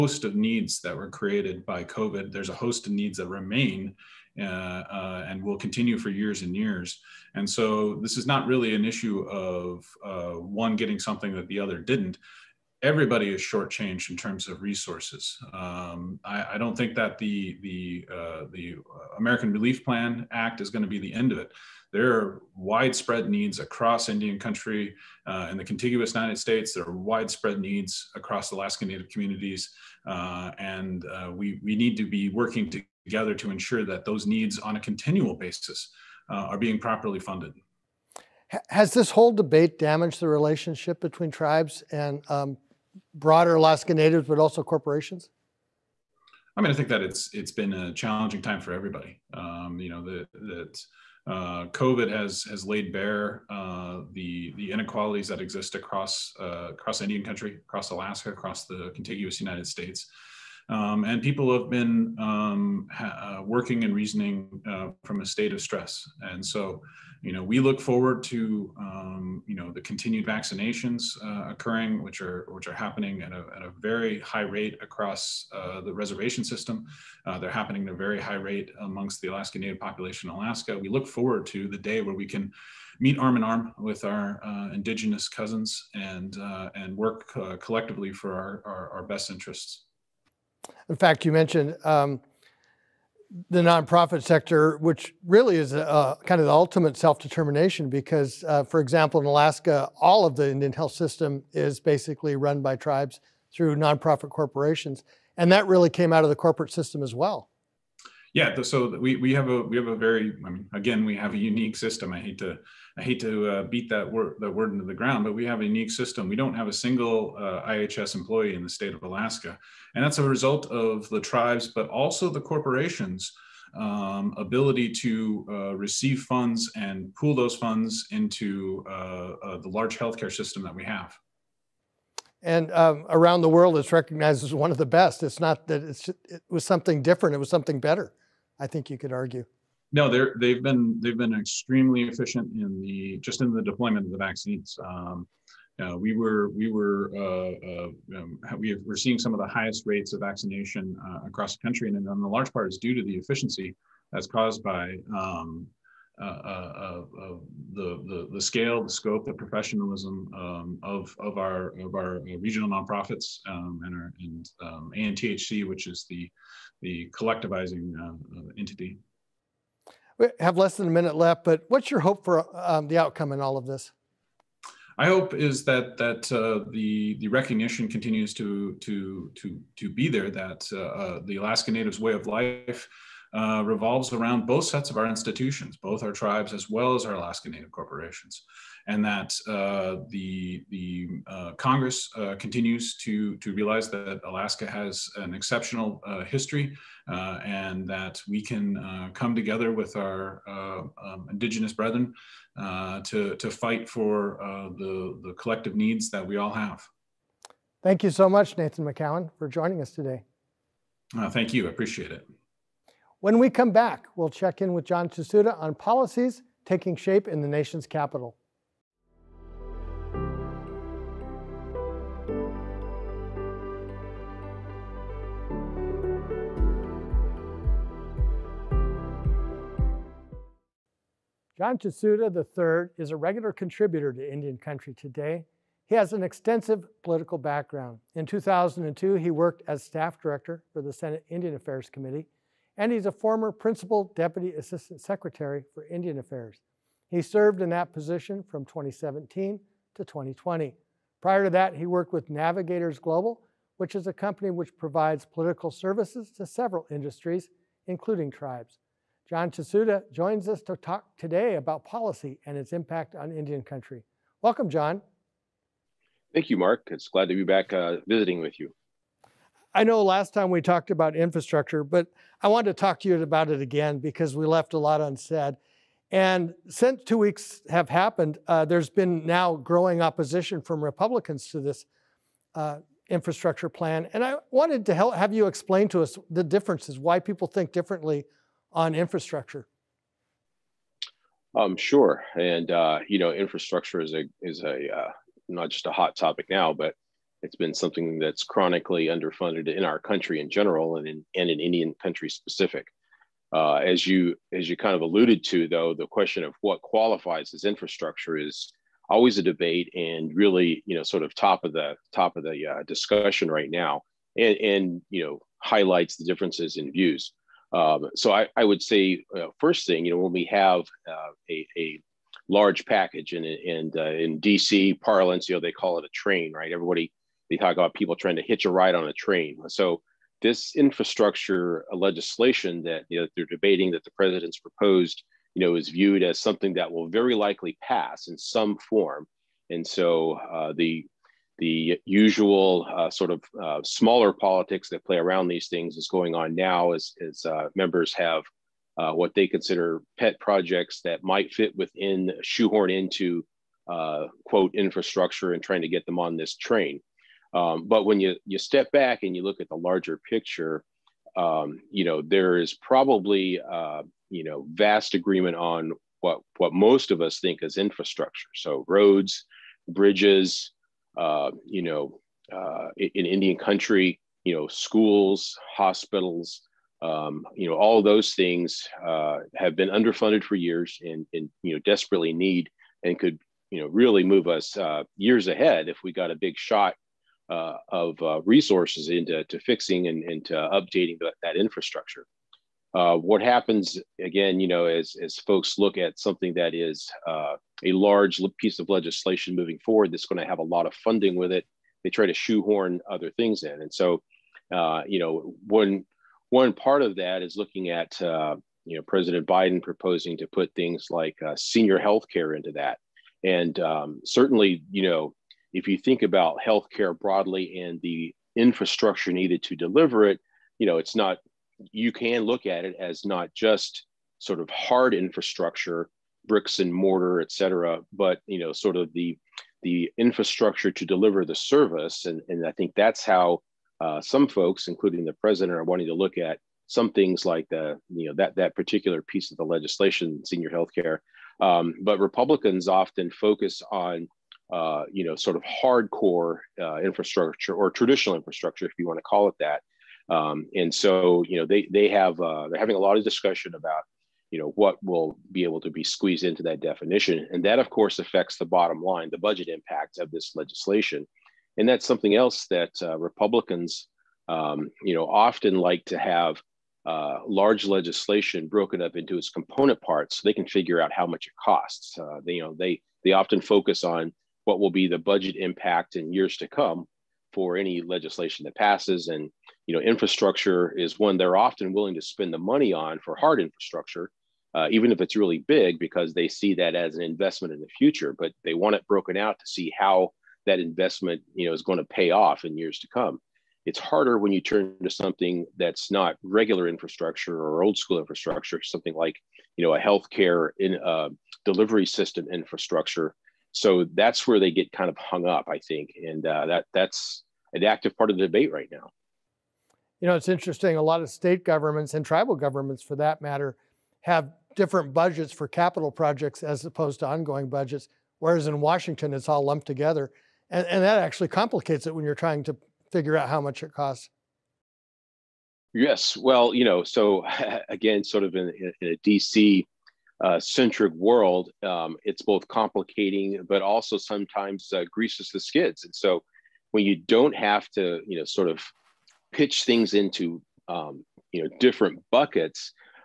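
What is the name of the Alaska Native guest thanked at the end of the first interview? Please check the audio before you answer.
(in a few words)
Nathan McCowan.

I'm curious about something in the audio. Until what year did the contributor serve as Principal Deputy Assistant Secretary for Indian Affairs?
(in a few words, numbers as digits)
2020.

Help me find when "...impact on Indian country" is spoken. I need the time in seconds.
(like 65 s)
262 s.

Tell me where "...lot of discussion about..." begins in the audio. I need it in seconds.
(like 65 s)
452 s.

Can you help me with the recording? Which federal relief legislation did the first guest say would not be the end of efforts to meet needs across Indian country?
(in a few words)
American Relief Plan Act.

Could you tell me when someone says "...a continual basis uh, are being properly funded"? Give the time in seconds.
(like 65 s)
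34 s.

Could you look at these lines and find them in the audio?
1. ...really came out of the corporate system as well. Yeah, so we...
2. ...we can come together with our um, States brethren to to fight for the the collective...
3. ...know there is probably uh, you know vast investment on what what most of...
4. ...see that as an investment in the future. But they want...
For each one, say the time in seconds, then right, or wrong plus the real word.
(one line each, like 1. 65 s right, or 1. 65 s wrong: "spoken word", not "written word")
1. 105 s right
2. 198 s wrong: "Indigenous", not "States"
3. 362 s wrong: "agreement", not "investment"
4. 486 s right.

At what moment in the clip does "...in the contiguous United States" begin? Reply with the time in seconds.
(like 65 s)
25 s.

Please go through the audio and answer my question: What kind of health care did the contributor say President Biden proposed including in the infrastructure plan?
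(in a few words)
senior health care.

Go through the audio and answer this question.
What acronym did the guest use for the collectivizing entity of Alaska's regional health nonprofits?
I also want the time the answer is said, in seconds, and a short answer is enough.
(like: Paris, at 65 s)
ANTHC, at 164 s.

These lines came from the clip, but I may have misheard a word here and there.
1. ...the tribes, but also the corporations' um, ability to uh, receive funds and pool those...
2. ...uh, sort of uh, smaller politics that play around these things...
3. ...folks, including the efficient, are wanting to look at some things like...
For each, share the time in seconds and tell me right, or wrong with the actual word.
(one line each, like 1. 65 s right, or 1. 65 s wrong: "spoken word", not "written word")
1. 121 s right
2. 342 s right
3. 434 s wrong: "president", not "efficient".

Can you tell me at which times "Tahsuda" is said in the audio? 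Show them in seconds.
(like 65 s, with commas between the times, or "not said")
215 s, 231 s, 259 s.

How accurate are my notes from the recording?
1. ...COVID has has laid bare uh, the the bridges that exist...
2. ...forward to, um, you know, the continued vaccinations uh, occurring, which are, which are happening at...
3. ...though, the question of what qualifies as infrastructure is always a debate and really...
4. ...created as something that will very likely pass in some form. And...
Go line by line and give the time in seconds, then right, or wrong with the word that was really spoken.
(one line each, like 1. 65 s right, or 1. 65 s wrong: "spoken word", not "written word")
1. 51 s wrong: "inequalities", not "bridges"
2. 67 s right
3. 305 s right
4. 335 s wrong: "viewed", not "created".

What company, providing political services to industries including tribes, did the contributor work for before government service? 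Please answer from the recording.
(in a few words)
Navigators Global.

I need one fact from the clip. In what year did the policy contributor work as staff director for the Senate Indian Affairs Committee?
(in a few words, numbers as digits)
2002.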